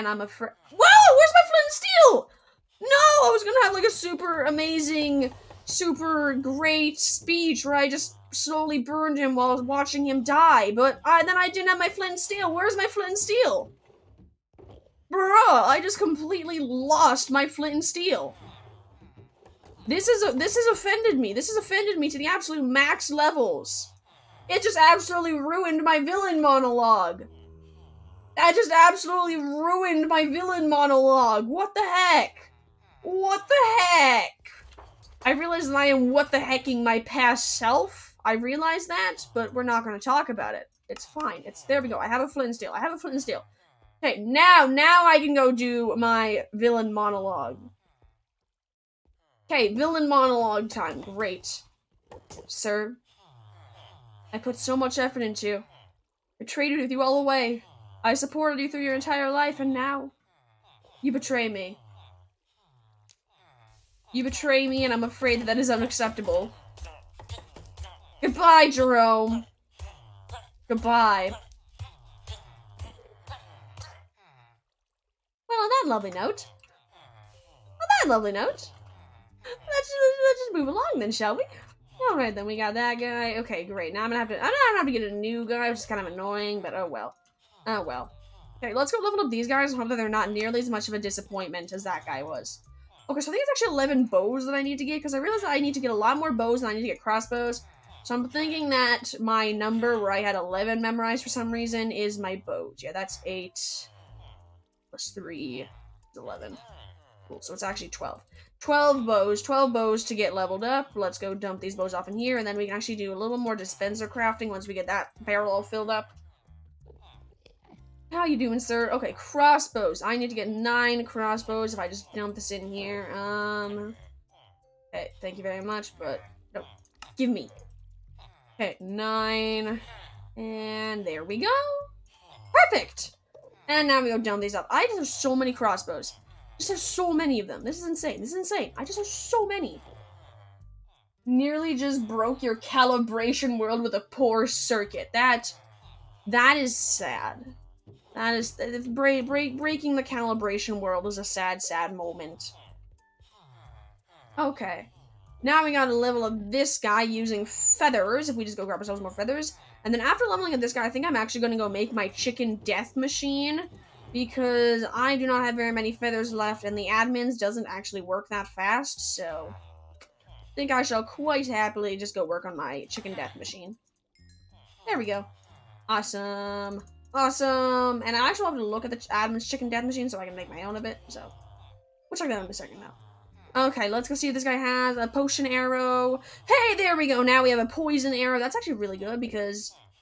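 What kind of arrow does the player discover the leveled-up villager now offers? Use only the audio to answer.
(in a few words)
Poison arrow.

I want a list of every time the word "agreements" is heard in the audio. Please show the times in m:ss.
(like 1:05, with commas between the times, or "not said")
not said.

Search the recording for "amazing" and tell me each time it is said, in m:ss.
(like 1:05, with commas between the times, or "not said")
0:04.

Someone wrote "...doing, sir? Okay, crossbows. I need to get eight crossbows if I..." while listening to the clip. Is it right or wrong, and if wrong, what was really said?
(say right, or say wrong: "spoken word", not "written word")
wrong: "nine", not "eight".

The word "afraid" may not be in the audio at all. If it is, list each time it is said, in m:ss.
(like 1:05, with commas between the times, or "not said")
0:00, 1:05.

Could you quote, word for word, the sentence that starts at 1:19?
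Let's just, let's just move along then, shall we?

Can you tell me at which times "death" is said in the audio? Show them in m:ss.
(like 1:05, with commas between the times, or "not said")
2:42, 2:53, 2:59.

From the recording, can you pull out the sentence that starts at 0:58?
I supported you through your entire life, and now you betray me.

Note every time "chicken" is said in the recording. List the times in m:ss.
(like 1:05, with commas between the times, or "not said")
2:42, 2:52, 2:59.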